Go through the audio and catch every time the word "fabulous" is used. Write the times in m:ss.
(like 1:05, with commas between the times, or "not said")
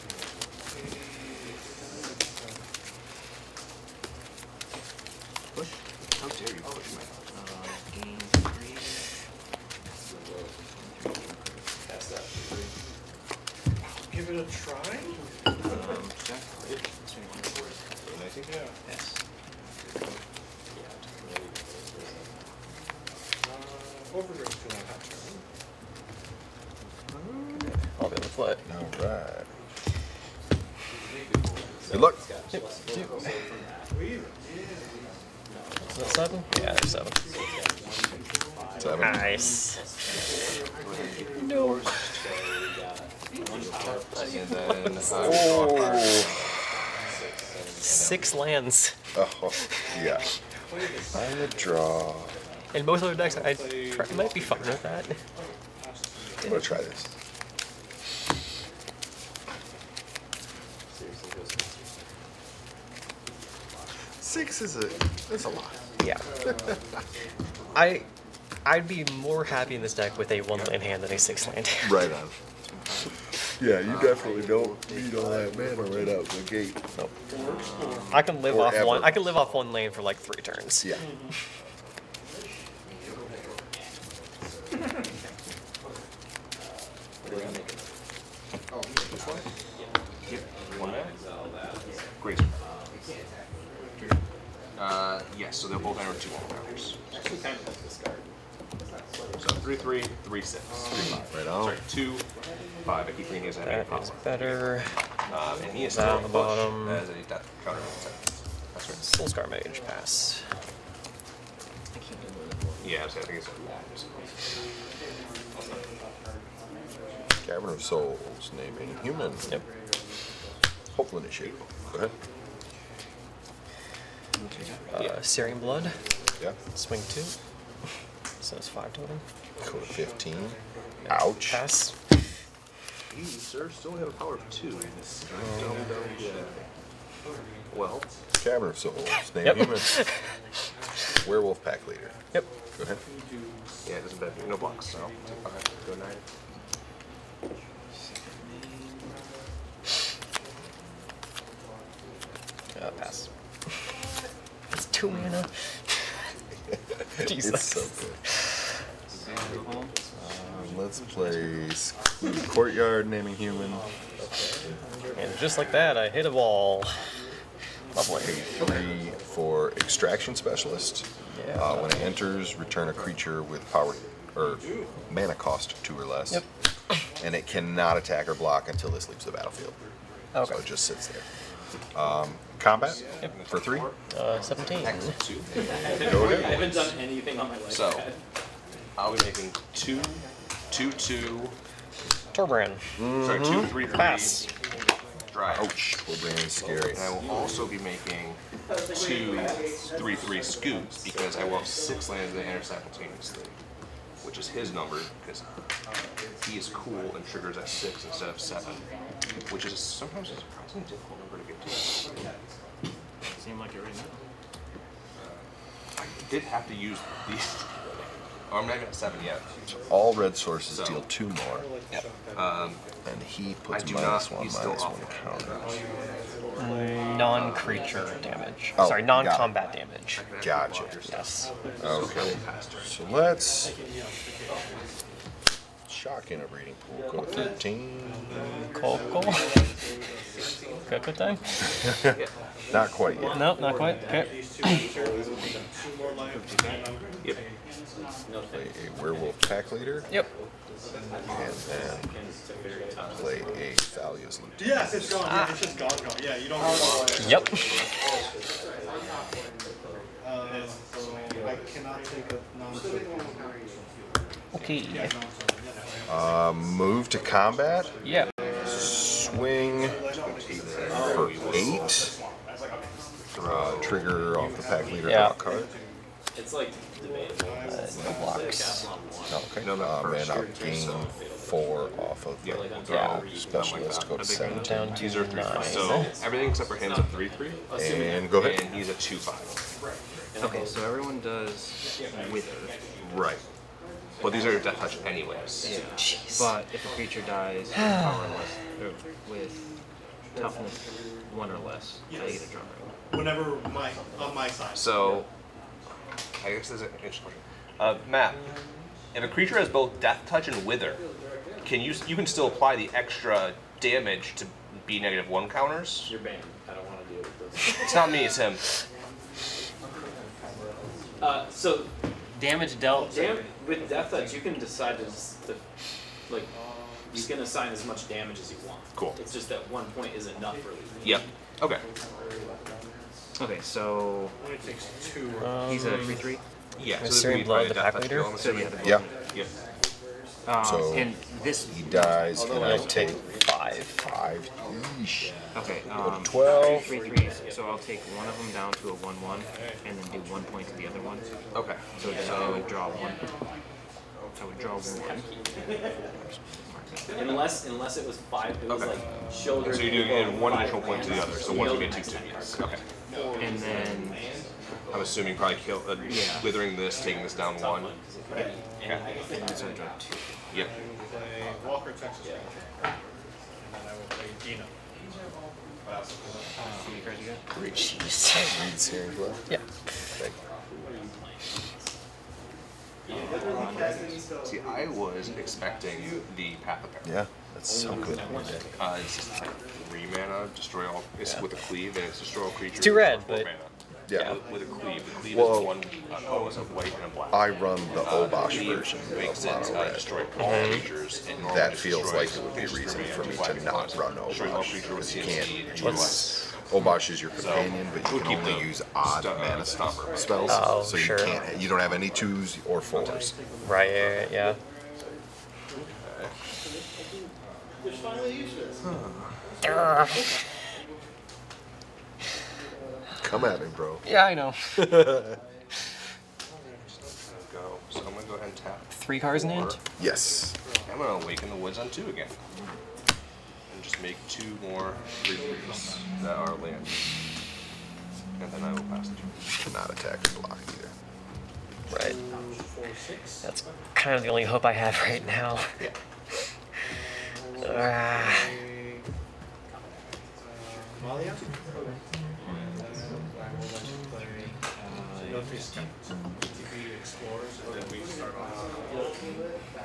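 not said.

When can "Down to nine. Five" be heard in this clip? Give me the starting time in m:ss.
4:44.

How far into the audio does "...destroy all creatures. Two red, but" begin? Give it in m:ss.
6:32.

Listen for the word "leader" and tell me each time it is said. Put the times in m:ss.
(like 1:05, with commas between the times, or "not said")
2:21, 4:09, 4:34, 5:37.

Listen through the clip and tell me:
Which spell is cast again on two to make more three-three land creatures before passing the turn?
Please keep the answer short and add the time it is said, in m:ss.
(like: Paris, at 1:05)
Awaken the Woods, at 7:11.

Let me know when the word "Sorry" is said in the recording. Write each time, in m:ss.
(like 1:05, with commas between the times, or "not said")
1:41, 3:13, 3:48.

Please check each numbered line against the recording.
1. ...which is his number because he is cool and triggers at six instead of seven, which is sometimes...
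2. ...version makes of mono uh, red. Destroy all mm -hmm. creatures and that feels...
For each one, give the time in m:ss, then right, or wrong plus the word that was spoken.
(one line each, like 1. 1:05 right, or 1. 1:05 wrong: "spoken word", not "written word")
1. 3:24 right
2. 6:38 right.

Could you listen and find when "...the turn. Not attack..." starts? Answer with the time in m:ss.
7:19.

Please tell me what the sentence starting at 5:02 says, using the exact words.
I get a drum Whenever my on my side.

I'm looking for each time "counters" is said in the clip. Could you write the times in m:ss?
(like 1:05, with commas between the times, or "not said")
1:47, 3:45, 5:15.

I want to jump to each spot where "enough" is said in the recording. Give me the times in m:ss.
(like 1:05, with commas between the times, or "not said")
5:30.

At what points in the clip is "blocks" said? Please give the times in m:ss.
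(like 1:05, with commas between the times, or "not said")
2:24, 2:58, 4:38, 7:20.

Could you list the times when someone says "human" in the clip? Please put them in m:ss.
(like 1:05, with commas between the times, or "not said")
1:59, 2:19, 2:43.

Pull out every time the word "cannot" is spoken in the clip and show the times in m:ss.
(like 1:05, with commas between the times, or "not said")
2:57, 4:21.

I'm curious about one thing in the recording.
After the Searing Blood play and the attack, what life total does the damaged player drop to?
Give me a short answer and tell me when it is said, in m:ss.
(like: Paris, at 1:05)
15, at 2:09.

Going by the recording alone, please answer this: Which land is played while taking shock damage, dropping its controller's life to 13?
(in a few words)
Breeding Pool.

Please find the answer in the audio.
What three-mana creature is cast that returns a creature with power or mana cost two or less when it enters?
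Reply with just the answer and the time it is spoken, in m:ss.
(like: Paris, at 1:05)
Extraction Specialist, at 2:49.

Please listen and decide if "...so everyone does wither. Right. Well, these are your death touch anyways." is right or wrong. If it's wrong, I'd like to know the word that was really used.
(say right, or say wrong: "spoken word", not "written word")
right.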